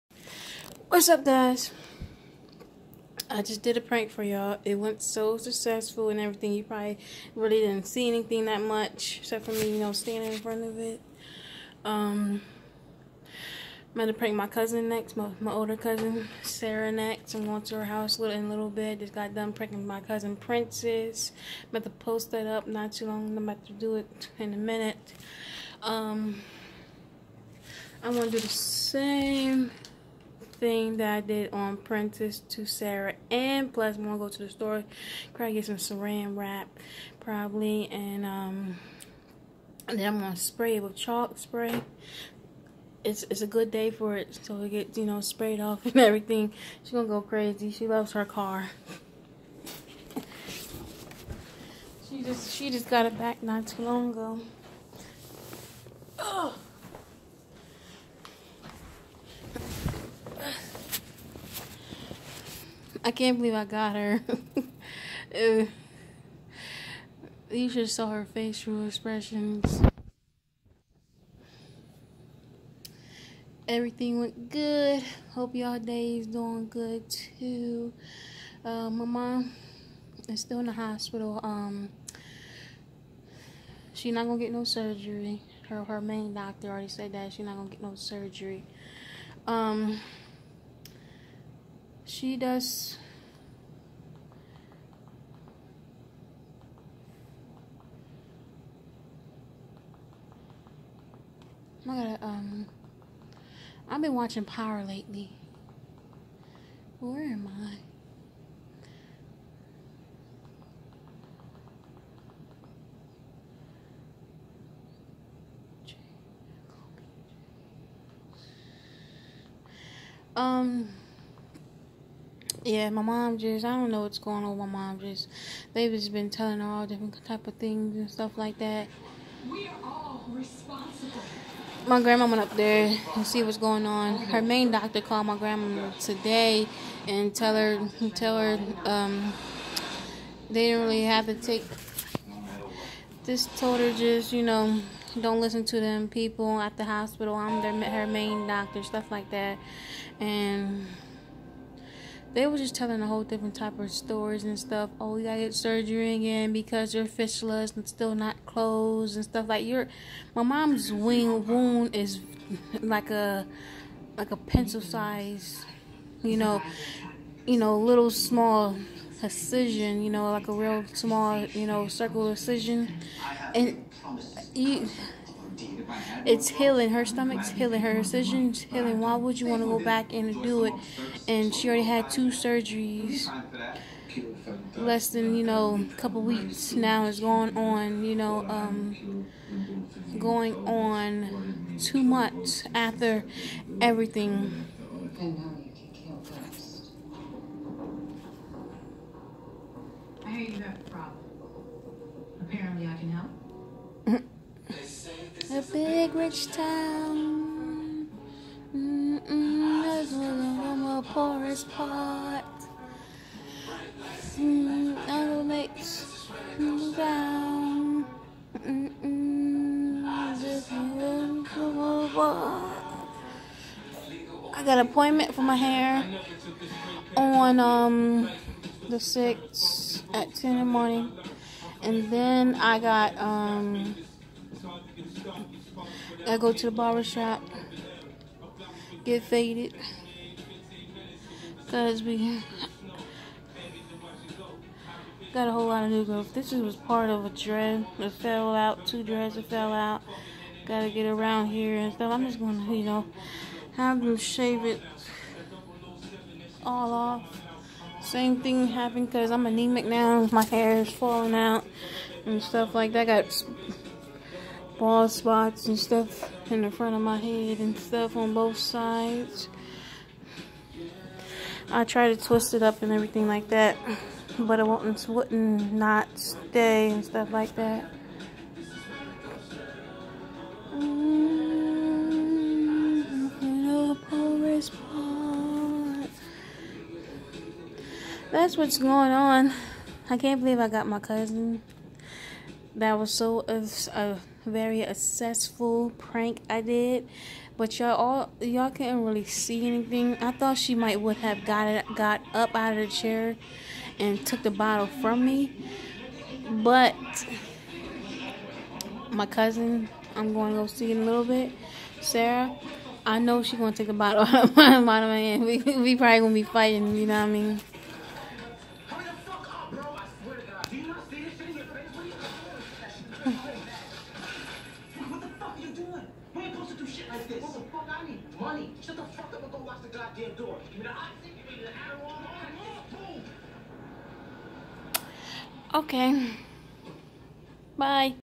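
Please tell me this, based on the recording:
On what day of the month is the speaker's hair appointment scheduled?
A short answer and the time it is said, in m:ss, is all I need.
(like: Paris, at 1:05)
The 6th, at 3:48.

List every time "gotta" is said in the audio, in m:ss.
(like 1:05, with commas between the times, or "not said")
2:35, 4:10.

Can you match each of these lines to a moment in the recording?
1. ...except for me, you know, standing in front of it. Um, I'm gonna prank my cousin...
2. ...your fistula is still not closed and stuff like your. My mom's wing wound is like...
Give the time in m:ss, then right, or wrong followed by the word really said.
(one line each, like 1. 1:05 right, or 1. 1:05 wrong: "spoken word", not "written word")
1. 0:09 right
2. 2:36 right.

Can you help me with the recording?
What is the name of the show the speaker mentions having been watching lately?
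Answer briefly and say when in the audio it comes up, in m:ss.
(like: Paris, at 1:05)
Power, at 1:44.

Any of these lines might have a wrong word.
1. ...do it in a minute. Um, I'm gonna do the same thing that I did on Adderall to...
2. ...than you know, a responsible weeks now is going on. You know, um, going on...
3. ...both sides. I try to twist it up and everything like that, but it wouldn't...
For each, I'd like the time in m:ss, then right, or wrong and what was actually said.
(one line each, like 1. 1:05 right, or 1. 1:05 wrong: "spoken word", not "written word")
1. 0:23 wrong: "Princess", not "Adderall"
2. 3:05 wrong: "couple", not "responsible"
3. 4:28 right.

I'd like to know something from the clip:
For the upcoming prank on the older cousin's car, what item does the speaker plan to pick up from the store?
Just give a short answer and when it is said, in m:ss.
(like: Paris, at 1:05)
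Saran wrap, at 0:35.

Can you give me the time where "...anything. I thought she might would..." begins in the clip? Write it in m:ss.
4:59.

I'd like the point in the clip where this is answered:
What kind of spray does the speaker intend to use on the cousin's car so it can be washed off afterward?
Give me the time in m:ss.
0:40.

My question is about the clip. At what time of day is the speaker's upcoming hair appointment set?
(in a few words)
10 in the morning.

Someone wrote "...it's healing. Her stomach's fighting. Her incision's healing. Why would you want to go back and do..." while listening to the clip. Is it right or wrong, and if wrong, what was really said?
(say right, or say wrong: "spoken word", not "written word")
wrong: "healing", not "fighting".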